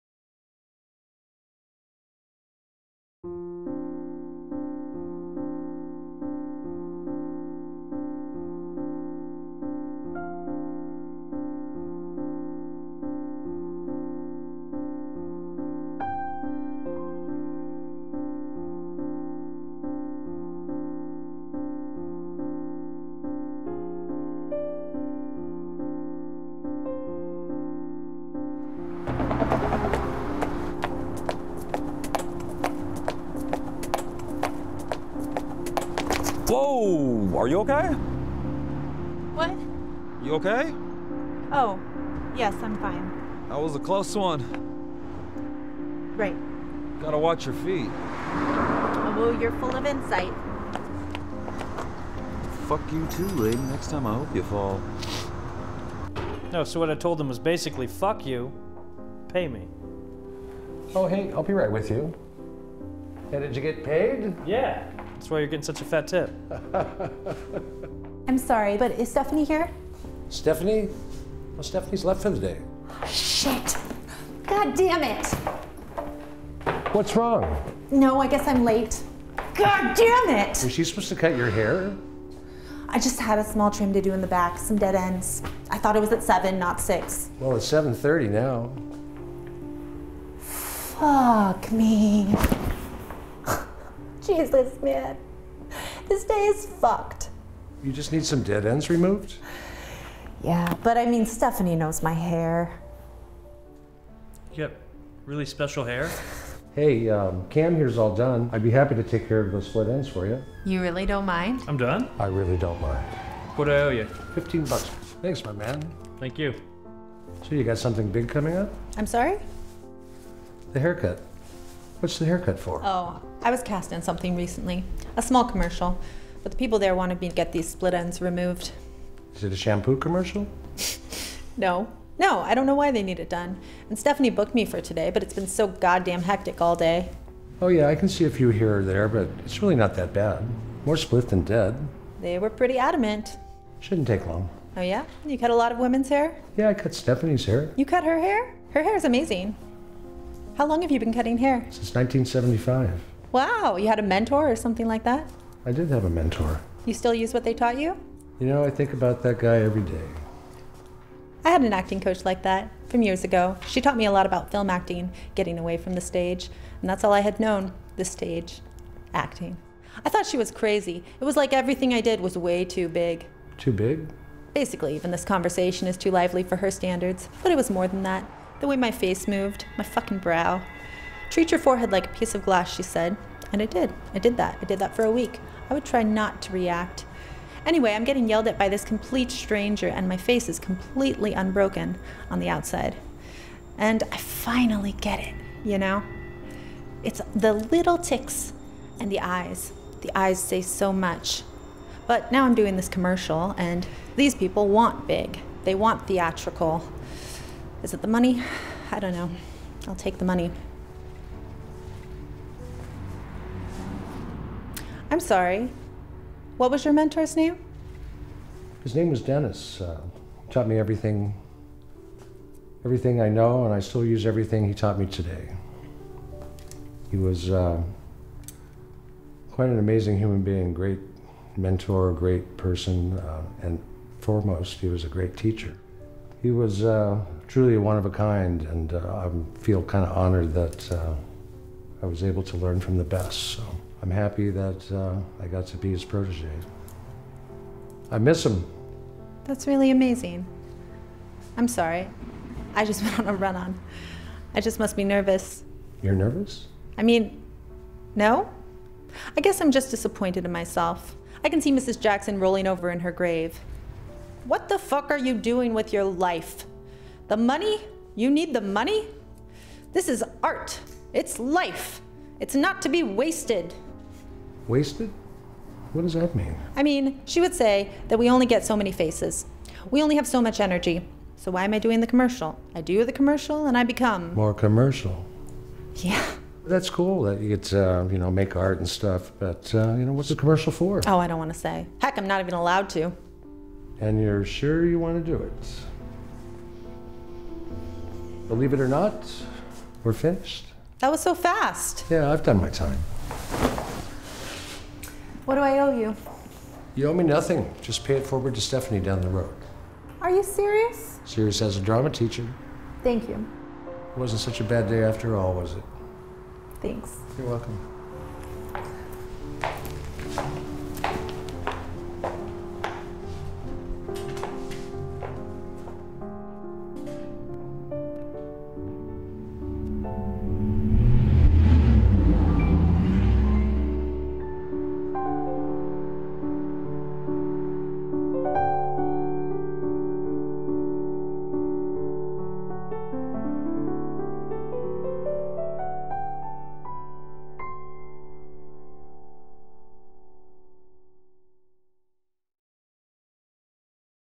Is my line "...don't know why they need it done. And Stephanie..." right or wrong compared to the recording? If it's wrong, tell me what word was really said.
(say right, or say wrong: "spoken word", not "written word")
right.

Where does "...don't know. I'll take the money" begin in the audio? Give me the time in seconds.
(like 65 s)
208 s.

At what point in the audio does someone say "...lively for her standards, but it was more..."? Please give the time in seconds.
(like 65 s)
176 s.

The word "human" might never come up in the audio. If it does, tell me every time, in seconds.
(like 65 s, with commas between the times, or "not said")
230 s.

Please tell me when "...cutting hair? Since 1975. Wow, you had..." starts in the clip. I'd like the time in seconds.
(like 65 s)
151 s.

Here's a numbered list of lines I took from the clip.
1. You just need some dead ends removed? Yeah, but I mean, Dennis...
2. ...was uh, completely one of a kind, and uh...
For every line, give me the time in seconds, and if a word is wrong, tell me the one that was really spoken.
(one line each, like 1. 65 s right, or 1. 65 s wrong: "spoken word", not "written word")
1. 97 s wrong: "Stephanie", not "Dennis"
2. 236 s wrong: "truly", not "completely".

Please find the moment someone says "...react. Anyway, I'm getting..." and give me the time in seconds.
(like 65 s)
186 s.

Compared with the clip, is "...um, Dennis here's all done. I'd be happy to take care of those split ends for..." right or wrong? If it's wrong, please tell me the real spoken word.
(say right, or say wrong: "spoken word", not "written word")
wrong: "Cam", not "Dennis".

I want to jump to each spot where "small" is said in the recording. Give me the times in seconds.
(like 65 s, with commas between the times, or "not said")
83 s, 125 s.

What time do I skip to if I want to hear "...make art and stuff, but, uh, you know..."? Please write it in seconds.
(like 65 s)
288 s.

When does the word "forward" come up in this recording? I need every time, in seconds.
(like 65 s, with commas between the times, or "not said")
308 s.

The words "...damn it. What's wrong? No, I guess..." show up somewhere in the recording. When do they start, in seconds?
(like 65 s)
74 s.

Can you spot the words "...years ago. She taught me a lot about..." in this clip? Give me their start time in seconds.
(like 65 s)
163 s.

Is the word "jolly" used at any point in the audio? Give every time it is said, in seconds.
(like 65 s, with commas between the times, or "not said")
not said.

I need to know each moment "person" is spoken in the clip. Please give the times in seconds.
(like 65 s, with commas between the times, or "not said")
232 s.